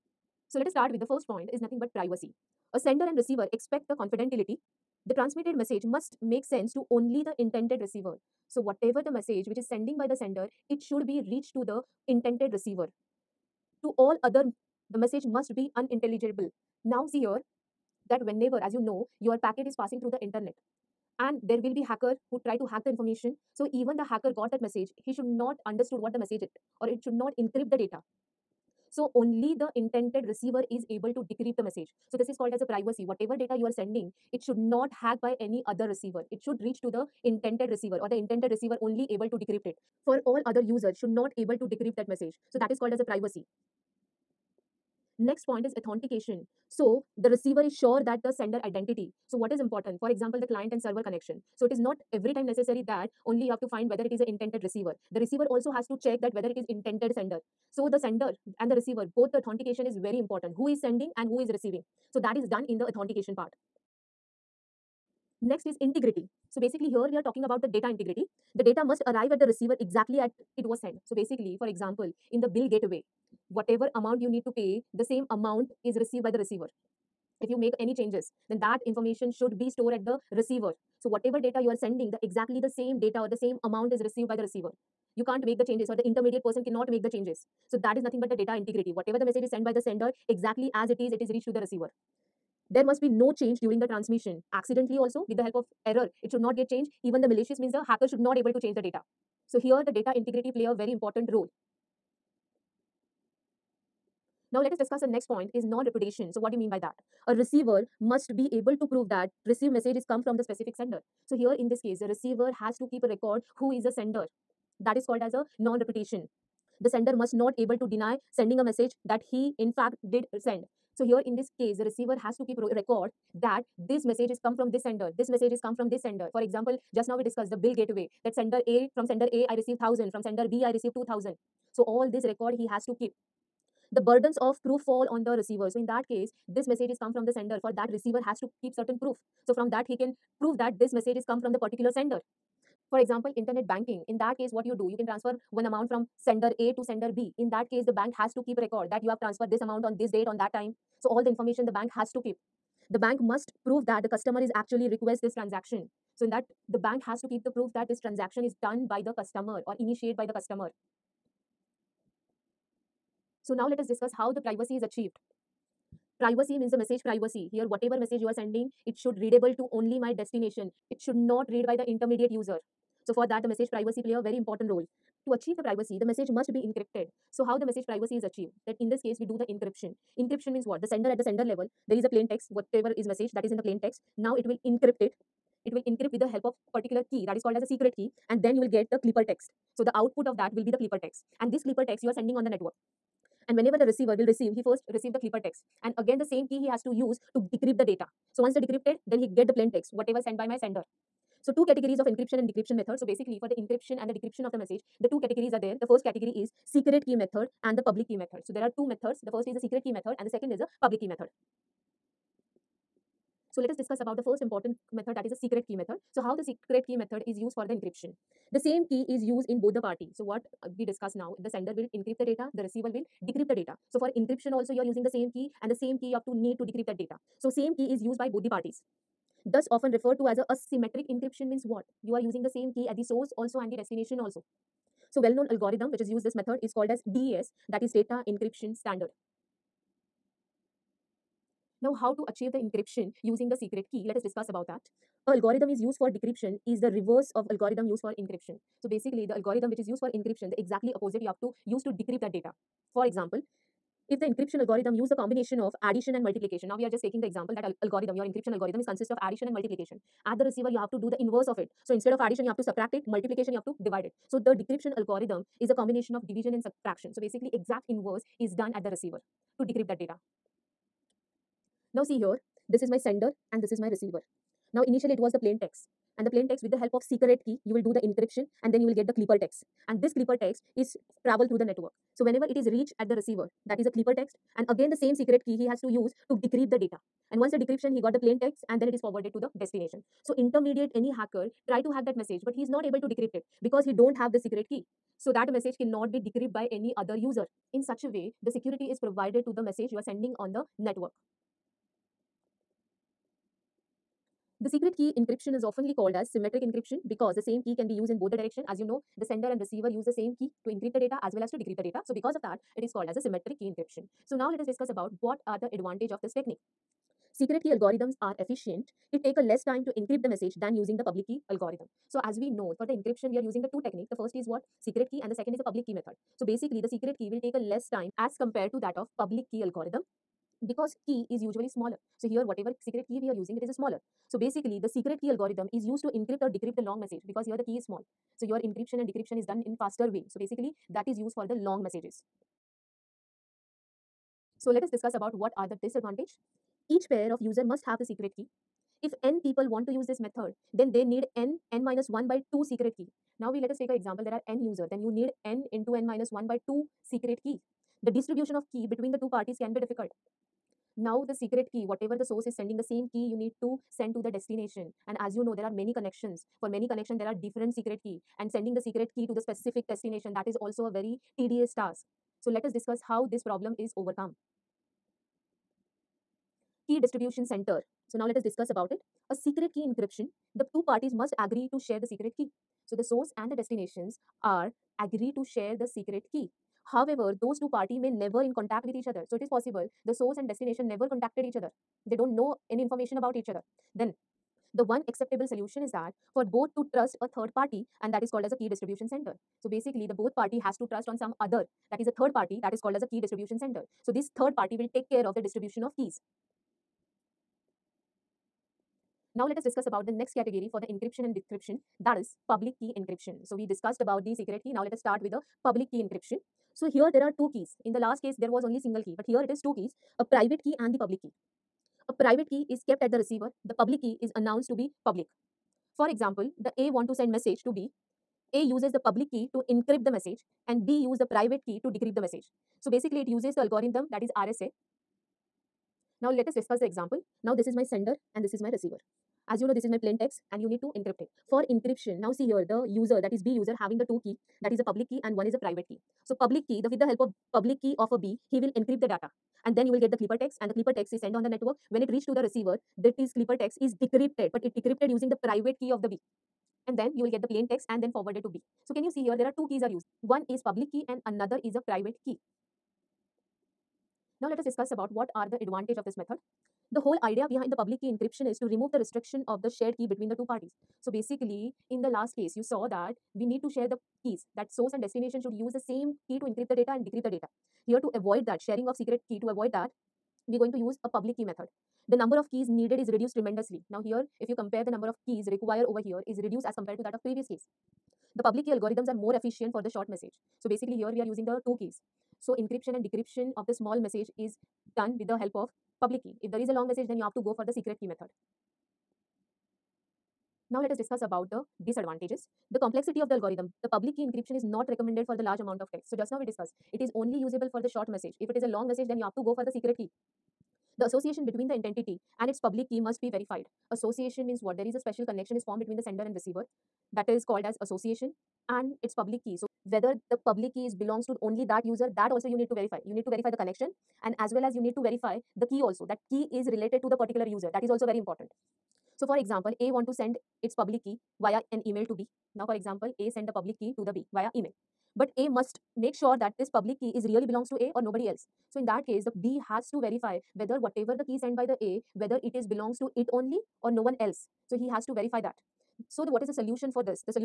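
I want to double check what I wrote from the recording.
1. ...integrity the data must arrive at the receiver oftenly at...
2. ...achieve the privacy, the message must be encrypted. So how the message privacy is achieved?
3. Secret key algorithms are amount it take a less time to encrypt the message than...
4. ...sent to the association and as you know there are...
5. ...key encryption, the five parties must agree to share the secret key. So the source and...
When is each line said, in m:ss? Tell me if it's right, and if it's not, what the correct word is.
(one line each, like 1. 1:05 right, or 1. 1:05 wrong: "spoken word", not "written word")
1. 1:07 wrong: "exactly", not "oftenly"
2. 2:55 right
3. 5:17 wrong: "efficient", not "amount"
4. 6:03 wrong: "destination", not "association"
5. 6:19 wrong: "two", not "five".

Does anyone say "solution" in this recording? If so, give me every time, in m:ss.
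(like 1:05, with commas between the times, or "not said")
6:35, 9:06.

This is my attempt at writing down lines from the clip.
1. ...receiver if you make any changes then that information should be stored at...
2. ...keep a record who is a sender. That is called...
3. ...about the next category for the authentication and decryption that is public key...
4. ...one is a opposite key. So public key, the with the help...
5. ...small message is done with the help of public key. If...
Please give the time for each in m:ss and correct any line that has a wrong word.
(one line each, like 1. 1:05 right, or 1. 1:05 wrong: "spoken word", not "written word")
1. 1:16 right
2. 1:52 right
3. 6:49 wrong: "encryption", not "authentication"
4. 7:25 wrong: "private", not "opposite"
5. 8:13 right.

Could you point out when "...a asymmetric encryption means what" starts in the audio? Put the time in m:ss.
3:50.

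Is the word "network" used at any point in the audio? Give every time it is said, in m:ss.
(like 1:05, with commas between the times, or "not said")
3:12, 4:41, 5:00, 7:31.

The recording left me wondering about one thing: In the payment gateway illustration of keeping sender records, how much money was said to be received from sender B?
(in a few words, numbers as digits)
2000.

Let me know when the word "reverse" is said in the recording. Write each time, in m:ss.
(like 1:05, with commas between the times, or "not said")
4:06.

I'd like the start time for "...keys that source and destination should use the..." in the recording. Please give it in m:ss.
7:54.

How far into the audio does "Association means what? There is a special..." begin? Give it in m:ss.
8:33.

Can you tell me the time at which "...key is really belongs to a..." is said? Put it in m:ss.
8:57.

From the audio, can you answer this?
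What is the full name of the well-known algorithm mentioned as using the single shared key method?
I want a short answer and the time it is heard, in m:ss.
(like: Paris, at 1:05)
Data Encryption Standard, at 3:57.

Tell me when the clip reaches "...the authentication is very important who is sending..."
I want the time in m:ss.
0:59.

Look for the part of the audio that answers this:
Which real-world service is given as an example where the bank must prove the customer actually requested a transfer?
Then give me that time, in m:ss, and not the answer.
2:23.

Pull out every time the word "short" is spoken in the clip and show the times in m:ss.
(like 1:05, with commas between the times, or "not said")
8:09, 8:27.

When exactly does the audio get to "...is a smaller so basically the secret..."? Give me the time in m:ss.
5:33.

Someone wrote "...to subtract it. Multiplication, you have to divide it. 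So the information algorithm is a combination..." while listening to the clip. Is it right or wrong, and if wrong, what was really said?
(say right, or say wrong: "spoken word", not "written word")
wrong: "decryption", not "information".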